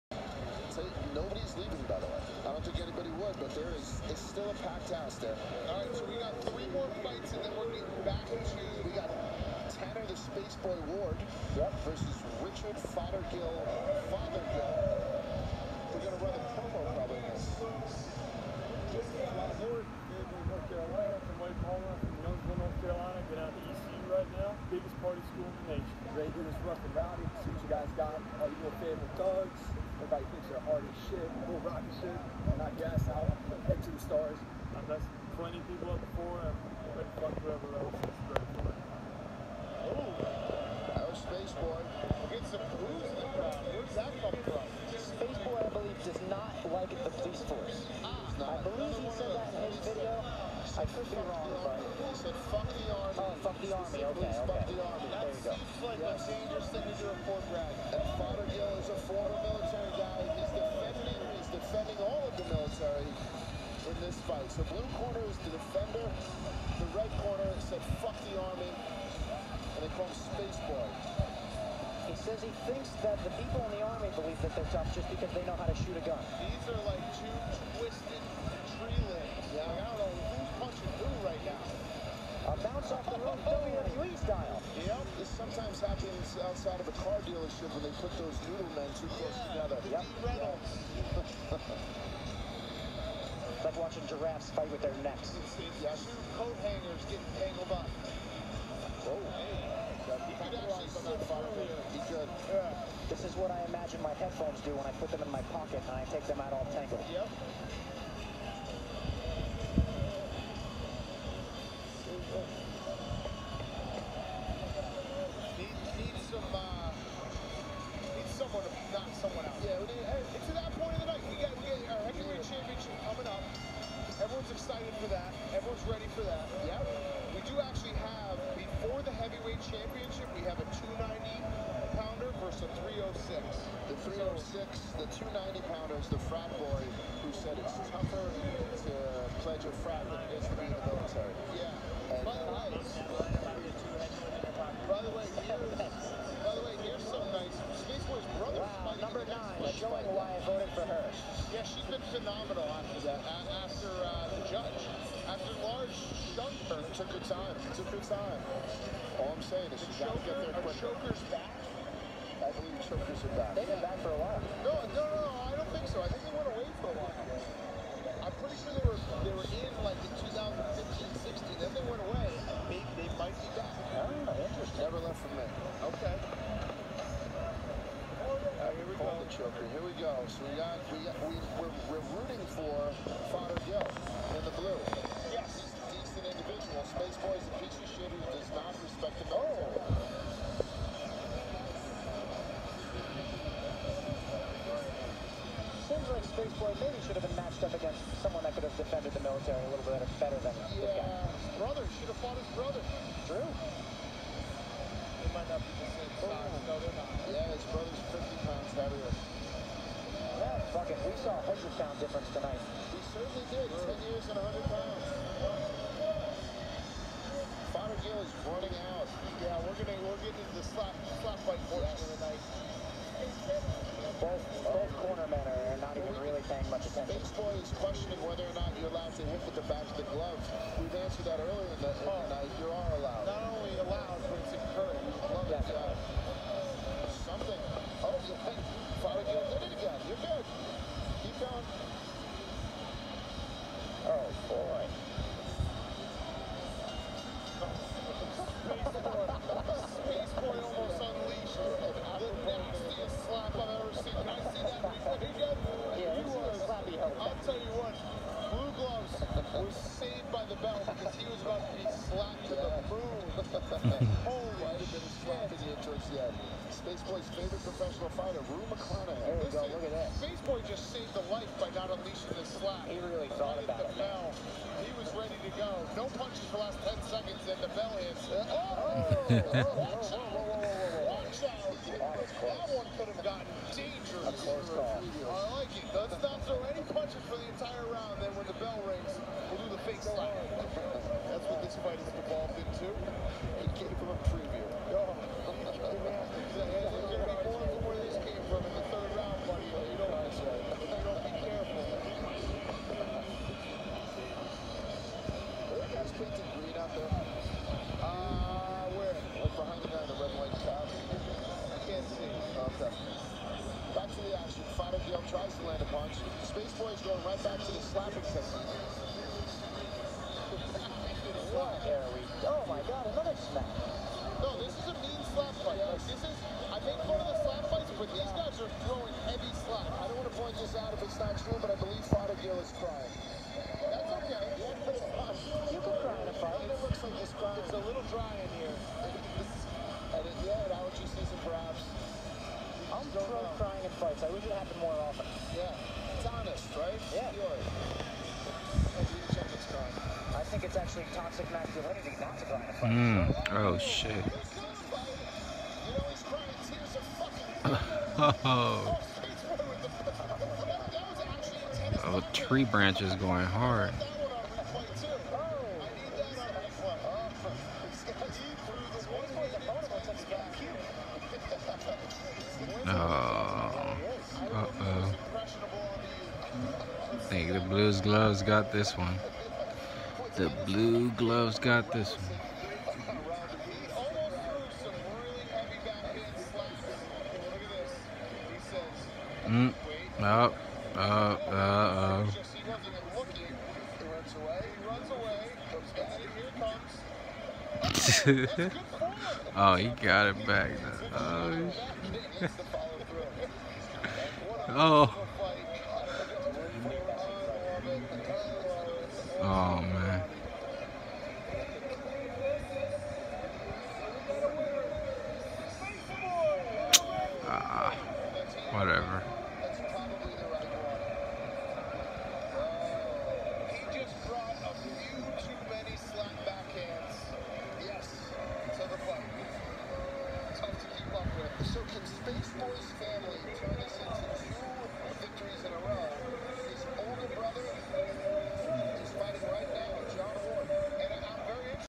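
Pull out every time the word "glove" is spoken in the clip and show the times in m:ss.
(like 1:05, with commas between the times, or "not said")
3:50, 6:18.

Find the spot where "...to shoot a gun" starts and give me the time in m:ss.
1:15.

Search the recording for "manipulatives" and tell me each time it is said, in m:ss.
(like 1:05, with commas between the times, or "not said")
not said.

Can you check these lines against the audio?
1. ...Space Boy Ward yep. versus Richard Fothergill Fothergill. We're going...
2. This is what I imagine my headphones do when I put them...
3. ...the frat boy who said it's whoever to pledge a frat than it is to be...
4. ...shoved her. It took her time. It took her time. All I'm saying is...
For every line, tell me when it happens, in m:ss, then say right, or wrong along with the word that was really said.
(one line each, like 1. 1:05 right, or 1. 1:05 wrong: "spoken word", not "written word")
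1. 0:10 right
2. 1:43 right
3. 2:16 wrong: "tougher", not "whoever"
4. 2:36 right.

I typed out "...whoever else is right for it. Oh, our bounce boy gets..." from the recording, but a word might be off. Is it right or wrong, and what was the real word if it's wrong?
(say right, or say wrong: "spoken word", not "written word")
wrong: "space", not "bounce".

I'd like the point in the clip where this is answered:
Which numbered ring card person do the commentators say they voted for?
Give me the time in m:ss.
2:28.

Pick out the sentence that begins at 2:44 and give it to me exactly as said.
No, no, no, I don't think so.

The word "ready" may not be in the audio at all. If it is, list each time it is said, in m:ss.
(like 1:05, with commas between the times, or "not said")
0:26, 2:05, 4:35.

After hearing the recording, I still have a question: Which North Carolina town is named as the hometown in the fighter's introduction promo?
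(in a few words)
Youngsville.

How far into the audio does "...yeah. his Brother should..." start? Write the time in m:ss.
3:20.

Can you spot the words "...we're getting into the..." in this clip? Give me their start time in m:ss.
3:40.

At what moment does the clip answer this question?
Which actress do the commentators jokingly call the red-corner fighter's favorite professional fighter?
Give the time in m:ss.
4:28.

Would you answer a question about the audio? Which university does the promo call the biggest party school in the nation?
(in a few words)
ECU.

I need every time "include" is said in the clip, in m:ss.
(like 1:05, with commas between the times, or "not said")
not said.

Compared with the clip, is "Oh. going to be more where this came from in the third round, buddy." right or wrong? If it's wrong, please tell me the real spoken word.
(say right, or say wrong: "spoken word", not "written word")
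right.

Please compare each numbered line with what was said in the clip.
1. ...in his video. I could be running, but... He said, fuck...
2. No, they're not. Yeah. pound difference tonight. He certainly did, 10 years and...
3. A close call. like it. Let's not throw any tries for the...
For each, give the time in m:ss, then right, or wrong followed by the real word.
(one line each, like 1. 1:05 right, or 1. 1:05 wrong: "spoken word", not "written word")
1. 0:49 wrong: "wrong", not "running"
2. 3:26 right
3. 4:44 wrong: "punches", not "tries".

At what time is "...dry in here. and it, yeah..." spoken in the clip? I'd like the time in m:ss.
5:38.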